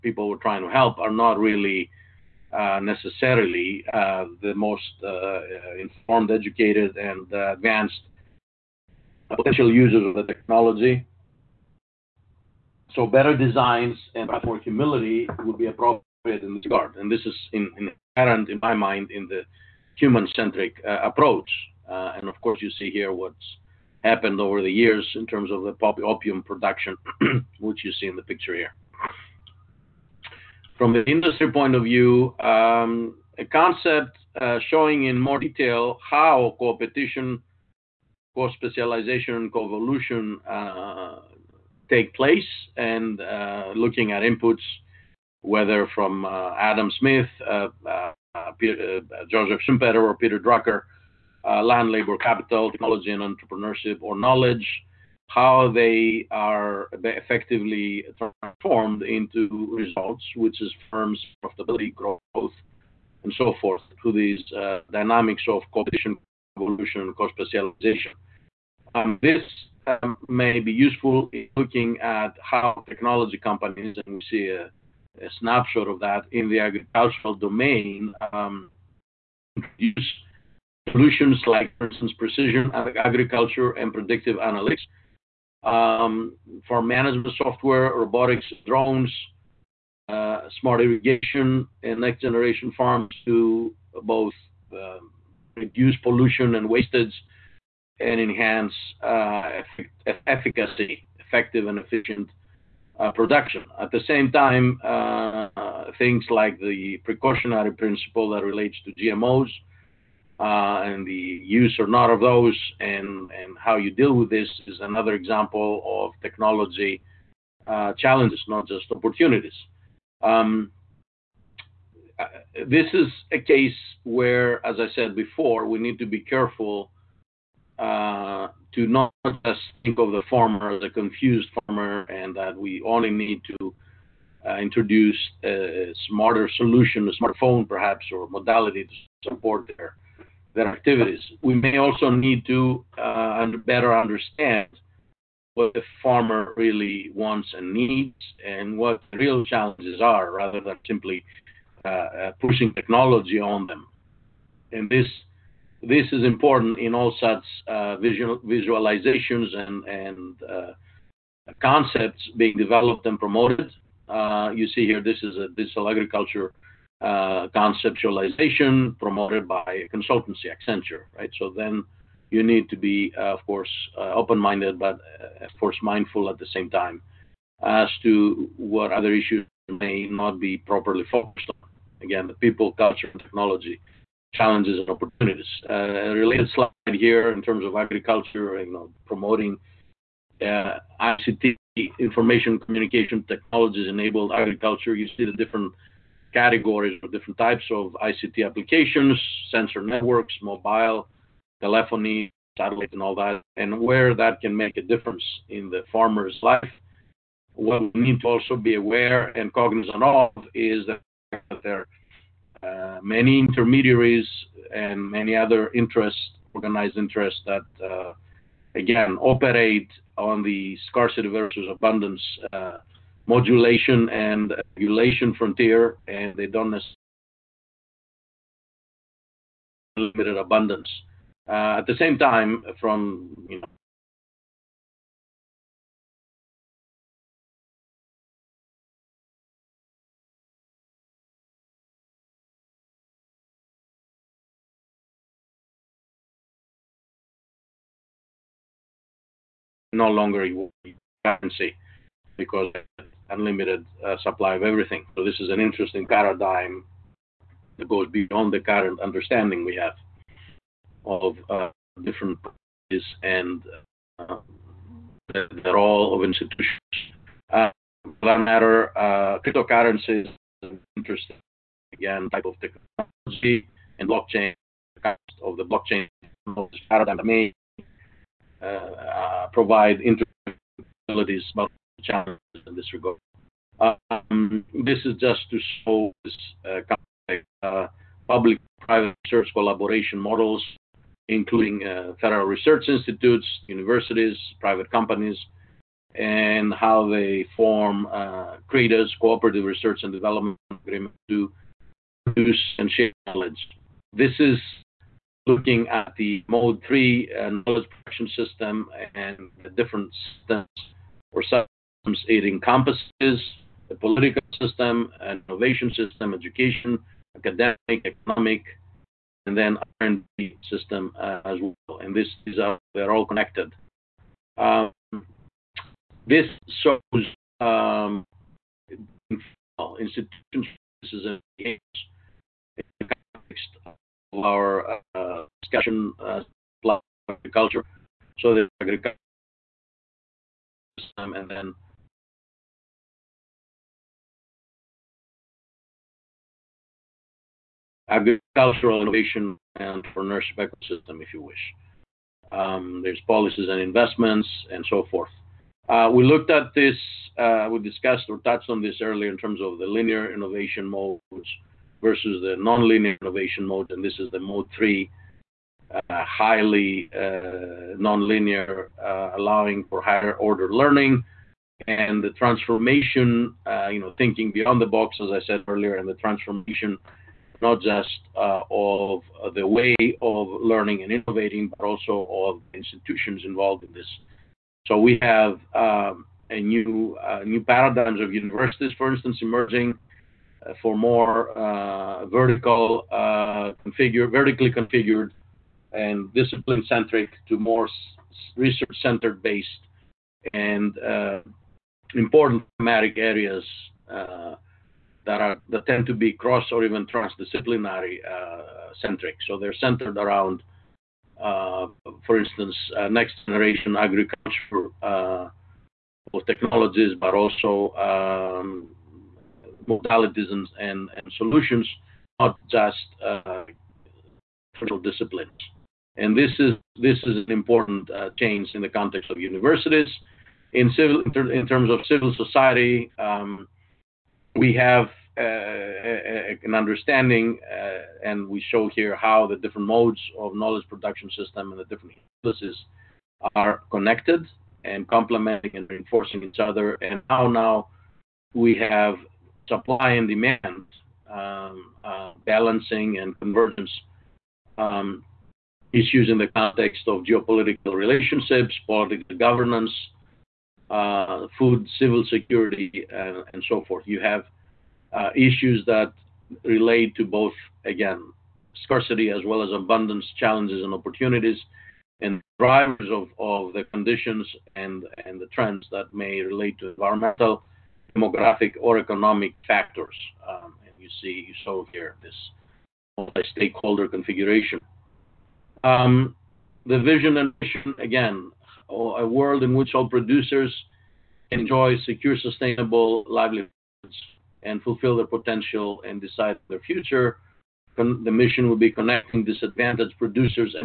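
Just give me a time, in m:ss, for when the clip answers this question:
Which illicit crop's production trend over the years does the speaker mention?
0:26.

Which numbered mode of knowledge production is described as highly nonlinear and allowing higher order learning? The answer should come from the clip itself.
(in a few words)
Mode 3.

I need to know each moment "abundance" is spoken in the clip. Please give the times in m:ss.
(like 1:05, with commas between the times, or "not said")
3:41, 3:50, 7:49.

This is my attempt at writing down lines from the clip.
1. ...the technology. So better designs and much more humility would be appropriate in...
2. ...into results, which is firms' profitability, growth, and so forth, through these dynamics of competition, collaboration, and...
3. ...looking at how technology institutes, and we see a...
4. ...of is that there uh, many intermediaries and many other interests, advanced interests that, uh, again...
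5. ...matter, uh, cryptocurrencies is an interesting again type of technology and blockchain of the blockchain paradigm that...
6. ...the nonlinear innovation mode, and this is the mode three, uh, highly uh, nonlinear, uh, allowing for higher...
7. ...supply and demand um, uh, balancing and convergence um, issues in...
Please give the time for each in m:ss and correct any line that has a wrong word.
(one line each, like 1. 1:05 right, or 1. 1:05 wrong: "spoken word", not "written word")
1. 0:10 right
2. 0:59 wrong: "evolution", not "collaboration"
3. 1:11 wrong: "companies", not "institutes"
4. 3:30 wrong: "organized", not "advanced"
5. 4:28 right
6. 6:02 right
7. 7:29 right.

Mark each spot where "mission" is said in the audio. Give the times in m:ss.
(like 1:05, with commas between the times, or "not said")
8:07, 8:18.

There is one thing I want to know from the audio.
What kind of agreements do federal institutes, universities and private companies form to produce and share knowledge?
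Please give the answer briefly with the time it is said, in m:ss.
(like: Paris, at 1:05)
Cooperative research and development agreements, at 4:59.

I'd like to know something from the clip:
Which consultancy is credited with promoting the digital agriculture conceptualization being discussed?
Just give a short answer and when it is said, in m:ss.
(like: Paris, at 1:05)
Accenture, at 2:50.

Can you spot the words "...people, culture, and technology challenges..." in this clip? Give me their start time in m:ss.
3:02.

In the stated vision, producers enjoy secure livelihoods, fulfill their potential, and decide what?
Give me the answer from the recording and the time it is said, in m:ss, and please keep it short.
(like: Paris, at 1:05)
Their future, at 8:16.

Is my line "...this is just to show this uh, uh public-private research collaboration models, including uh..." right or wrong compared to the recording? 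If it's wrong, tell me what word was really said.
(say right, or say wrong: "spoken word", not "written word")
right.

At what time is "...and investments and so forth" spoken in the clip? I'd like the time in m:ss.
5:53.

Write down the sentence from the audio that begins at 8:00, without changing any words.
Um, and you see, you saw here this multi-stakeholder configuration.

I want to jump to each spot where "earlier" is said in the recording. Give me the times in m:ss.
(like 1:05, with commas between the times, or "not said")
5:59, 6:15.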